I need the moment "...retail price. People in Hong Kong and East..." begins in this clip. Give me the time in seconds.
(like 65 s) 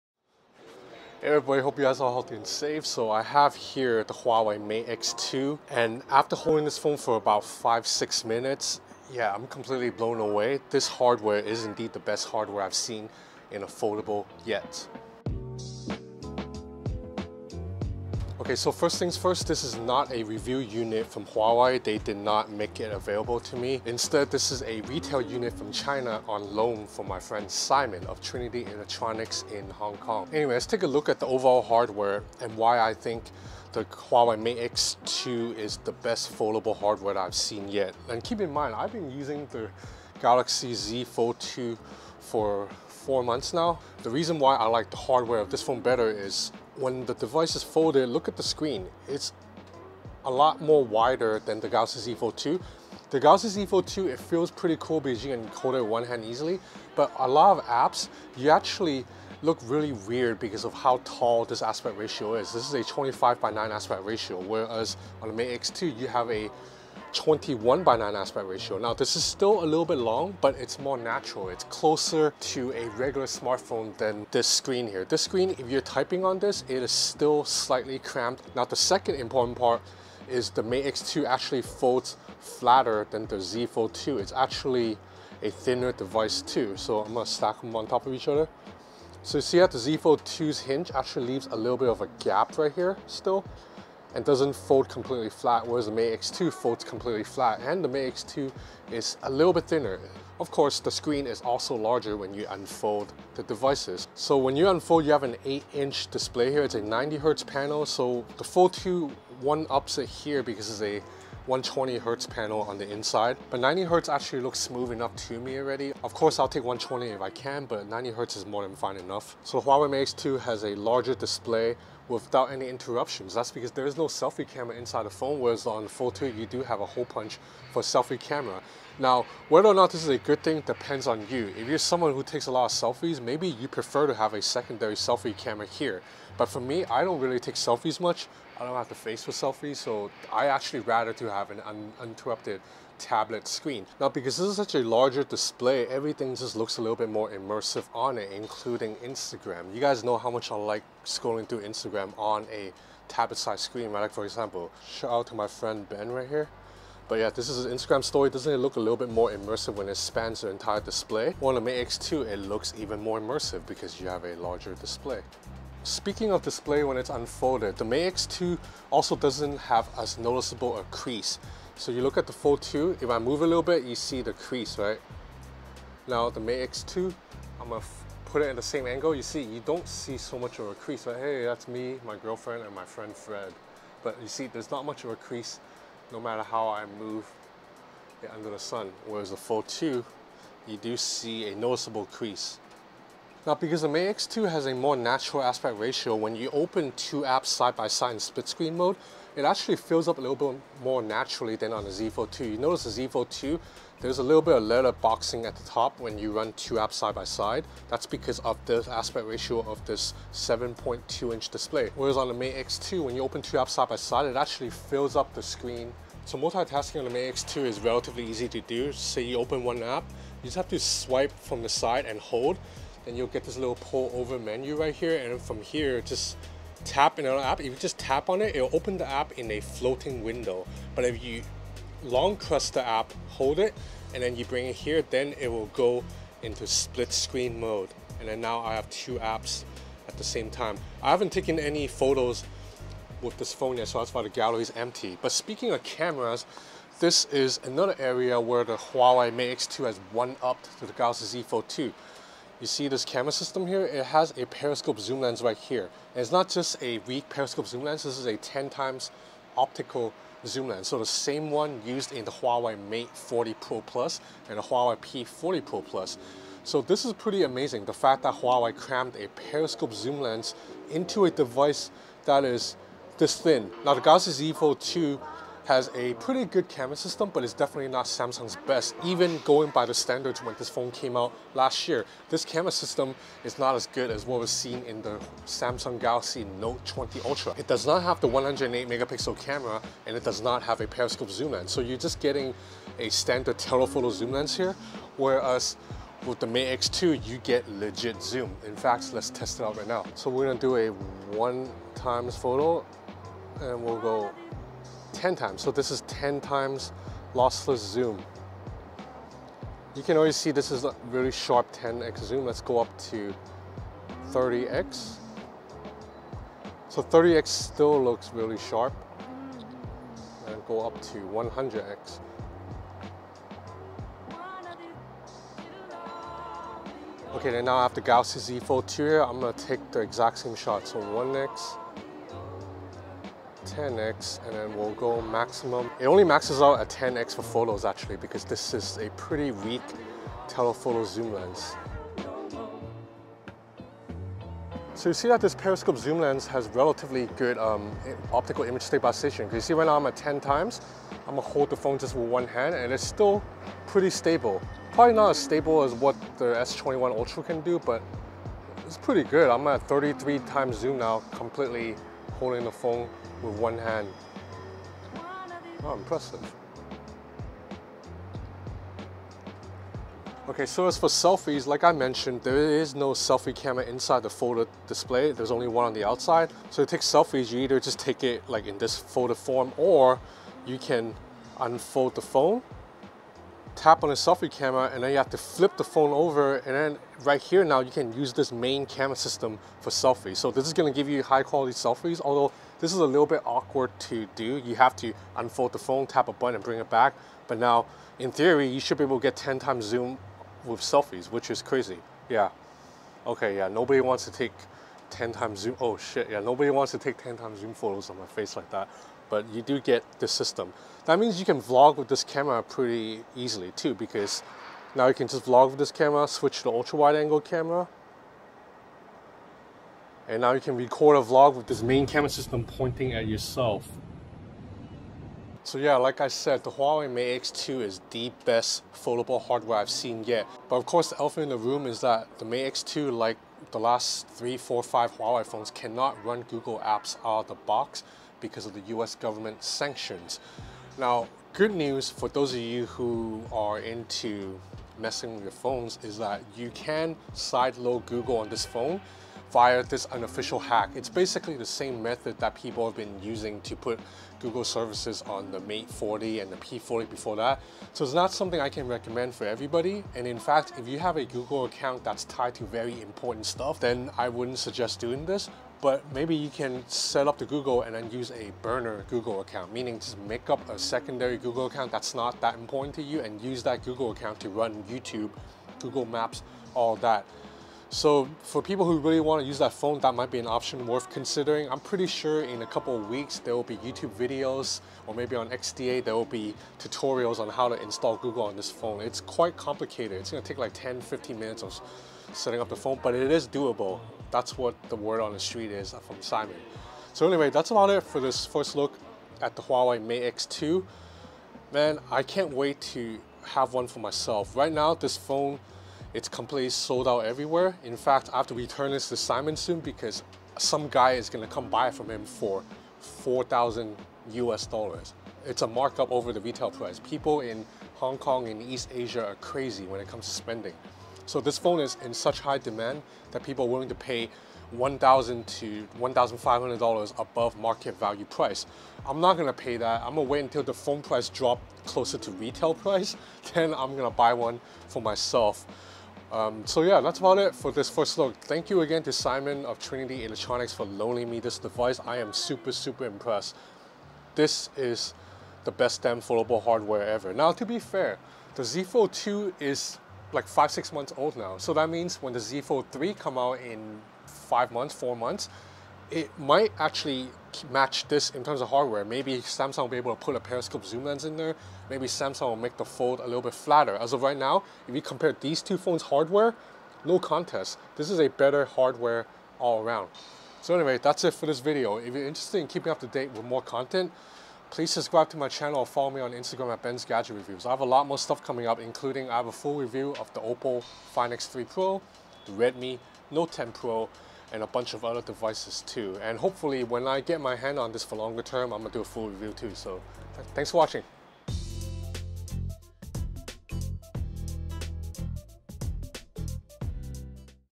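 516 s.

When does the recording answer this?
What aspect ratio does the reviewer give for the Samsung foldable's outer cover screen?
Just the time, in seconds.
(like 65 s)
62 s.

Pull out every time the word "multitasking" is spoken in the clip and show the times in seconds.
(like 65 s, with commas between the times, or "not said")
216 s.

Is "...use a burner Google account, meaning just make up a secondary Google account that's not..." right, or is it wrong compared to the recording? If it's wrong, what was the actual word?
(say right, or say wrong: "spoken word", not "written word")
right.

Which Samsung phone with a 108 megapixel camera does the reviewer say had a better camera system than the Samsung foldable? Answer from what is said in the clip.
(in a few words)
Galaxy Note 20 Ultra.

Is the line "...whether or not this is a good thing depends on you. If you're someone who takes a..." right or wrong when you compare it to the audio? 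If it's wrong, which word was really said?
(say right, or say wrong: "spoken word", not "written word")
right.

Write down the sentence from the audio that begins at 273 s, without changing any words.
Now the Galaxy Z Fold 2 has a pretty good camera system, but it's definitely not Samsung's best.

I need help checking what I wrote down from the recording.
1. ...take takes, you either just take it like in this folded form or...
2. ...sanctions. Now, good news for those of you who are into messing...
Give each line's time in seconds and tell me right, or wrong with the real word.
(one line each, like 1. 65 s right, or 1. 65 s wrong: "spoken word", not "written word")
1. 376 s wrong: "selfies", not "takes"
2. 439 s right.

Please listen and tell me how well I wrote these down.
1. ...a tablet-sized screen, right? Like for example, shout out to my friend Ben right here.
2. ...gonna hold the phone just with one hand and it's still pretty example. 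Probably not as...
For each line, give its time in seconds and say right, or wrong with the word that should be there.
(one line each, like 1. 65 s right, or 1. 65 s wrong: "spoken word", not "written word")
1. 152 s right
2. 351 s wrong: "stable", not "example".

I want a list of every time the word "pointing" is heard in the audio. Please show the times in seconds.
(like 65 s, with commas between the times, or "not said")
422 s.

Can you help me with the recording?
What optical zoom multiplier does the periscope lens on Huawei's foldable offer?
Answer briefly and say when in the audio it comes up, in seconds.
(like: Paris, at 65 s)
10 times, at 258 s.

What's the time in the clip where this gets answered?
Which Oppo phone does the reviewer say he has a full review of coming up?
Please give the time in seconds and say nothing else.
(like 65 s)
580 s.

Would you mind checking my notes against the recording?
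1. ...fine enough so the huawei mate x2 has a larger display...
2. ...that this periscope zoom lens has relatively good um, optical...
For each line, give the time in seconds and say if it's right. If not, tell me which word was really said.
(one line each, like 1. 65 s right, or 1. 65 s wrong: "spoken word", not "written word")
1. 118 s right
2. 345 s right.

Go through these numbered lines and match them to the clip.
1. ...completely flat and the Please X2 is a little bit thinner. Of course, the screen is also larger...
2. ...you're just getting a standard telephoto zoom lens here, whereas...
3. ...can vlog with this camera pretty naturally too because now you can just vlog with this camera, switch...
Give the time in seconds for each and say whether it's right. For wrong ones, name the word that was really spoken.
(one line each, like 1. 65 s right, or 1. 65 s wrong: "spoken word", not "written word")
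1. 96 s wrong: "Mate", not "Please"
2. 291 s right
3. 411 s wrong: "easily", not "naturally".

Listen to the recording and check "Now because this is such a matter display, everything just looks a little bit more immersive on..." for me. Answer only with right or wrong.
wrong.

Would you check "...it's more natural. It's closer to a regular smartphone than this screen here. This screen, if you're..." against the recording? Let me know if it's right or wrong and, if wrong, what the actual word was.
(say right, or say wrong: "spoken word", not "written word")
right.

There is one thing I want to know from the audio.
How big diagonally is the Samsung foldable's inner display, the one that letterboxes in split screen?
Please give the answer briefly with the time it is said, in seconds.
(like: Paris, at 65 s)
7.2 inches, at 210 s.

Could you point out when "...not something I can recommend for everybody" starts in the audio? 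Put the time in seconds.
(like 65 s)
458 s.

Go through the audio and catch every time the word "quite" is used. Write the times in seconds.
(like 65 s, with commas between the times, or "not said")
489 s.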